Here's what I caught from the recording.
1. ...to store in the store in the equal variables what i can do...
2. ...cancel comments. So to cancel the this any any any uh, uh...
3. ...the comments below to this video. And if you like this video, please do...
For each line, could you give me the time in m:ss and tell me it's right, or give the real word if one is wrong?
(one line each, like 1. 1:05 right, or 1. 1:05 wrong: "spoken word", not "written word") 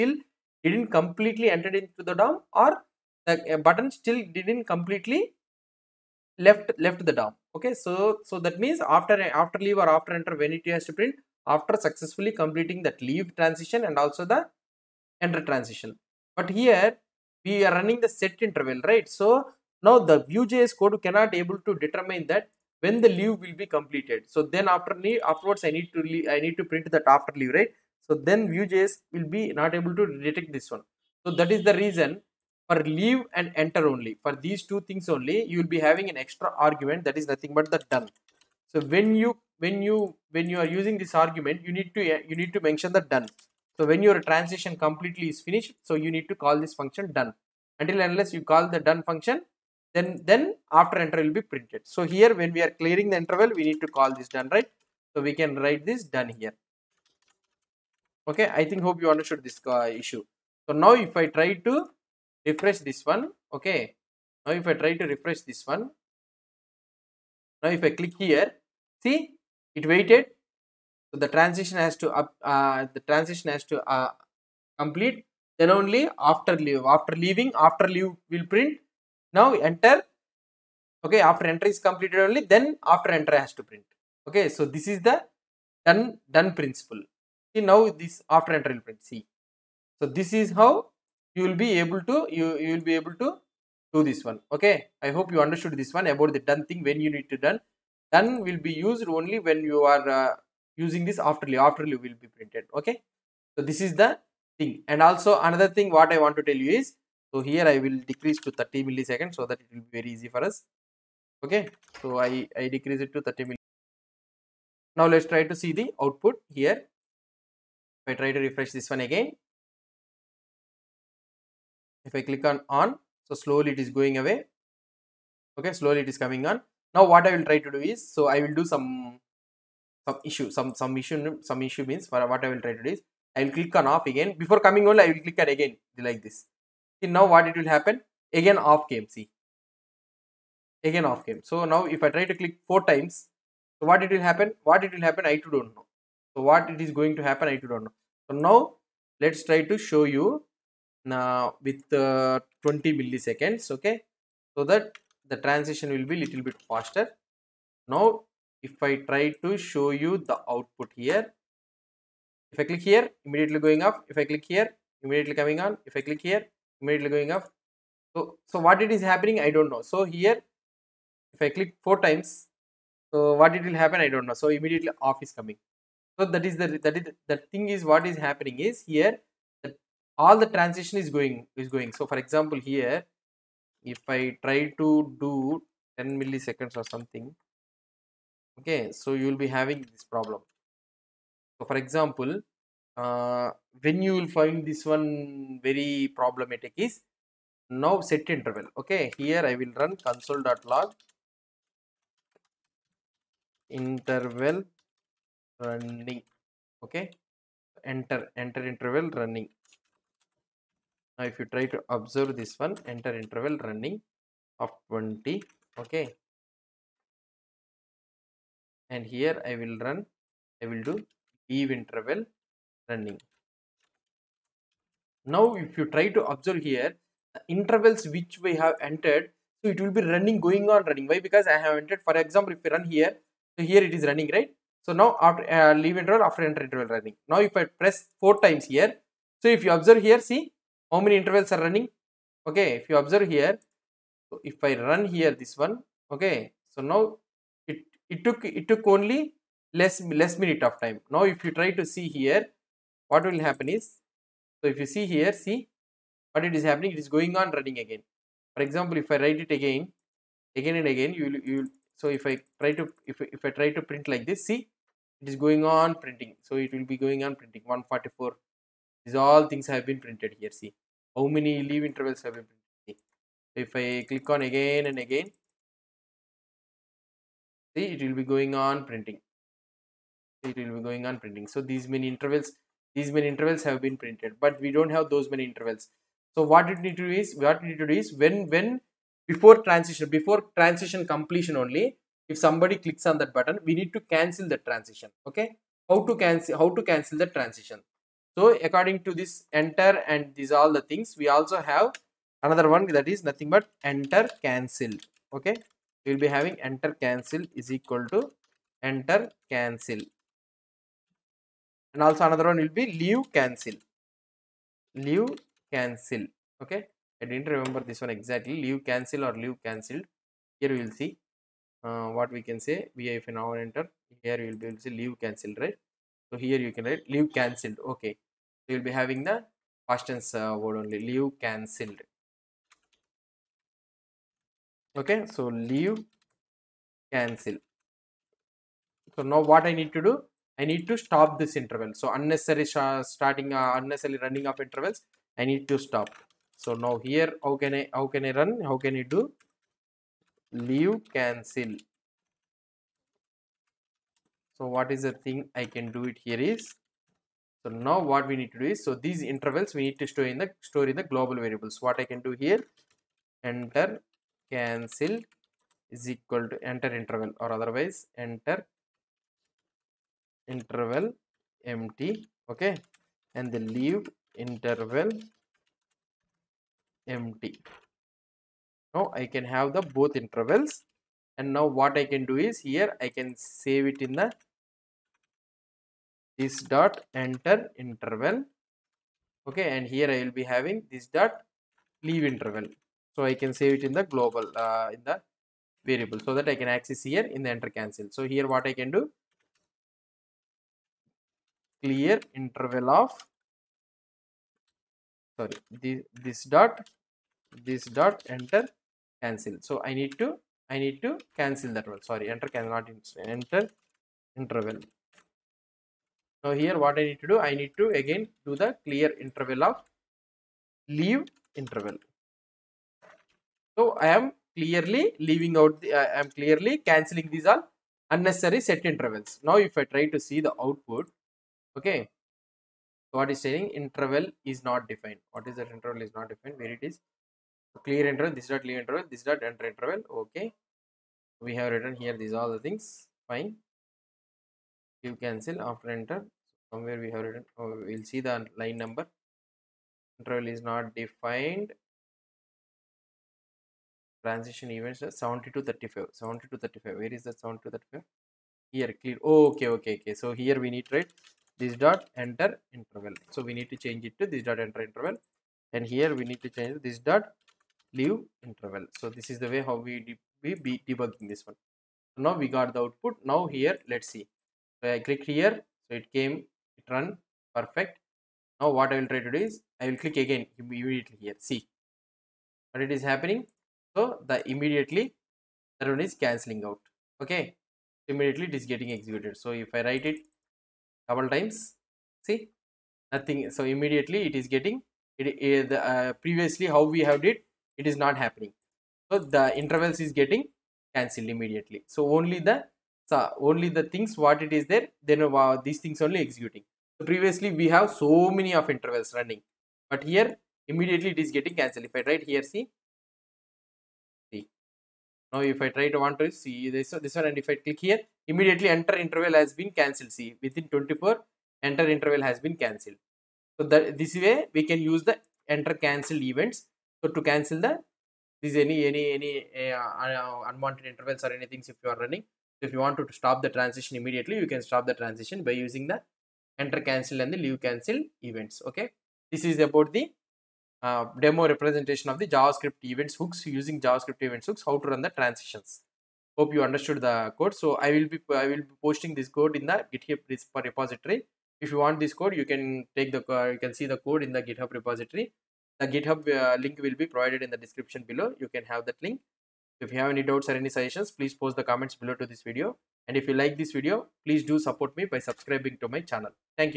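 1. 5:59 wrong: "global", not "equal"
2. 8:45 wrong: "events", not "comments"
3. 9:21 right.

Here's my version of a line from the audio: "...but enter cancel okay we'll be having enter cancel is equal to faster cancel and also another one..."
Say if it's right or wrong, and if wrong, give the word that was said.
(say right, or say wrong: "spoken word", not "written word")
wrong: "enter", not "faster".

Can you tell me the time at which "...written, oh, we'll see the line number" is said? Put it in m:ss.
7:27.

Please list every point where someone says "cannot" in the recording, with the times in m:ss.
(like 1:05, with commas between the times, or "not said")
0:21, 6:52.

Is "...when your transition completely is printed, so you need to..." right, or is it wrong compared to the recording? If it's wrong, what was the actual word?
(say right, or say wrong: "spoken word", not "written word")
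wrong: "finished", not "printed".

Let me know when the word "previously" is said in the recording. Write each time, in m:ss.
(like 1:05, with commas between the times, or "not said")
8:16, 8:27.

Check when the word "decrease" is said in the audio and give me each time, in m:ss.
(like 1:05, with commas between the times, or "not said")
1:48, 1:52.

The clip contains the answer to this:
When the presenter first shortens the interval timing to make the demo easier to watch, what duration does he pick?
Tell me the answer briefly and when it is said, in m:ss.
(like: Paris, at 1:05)
30 milliseconds, at 1:48.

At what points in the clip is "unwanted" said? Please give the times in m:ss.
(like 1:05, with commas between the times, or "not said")
8:50.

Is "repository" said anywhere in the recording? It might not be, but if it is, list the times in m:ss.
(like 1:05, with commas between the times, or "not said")
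9:10, 9:14.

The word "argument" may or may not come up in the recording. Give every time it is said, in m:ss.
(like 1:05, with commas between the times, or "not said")
0:36, 0:41.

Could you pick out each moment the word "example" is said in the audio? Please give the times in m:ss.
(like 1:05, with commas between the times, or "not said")
3:02, 3:11, 3:52, 4:18.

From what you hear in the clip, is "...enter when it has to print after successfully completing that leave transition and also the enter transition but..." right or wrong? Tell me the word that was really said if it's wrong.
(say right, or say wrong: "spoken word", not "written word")
right.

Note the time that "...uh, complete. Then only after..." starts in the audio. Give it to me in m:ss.
1:13.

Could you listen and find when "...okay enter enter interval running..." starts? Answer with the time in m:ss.
3:26.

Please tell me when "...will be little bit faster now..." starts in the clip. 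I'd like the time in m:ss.
2:35.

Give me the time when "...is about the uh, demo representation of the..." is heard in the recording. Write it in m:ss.
8:59.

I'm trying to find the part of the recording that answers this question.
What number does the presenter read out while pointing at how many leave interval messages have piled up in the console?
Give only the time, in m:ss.
4:27.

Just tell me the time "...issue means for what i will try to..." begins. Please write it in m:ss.
2:11.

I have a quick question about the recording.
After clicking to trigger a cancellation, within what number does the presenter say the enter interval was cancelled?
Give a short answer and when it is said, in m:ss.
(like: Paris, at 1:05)
24, at 8:40.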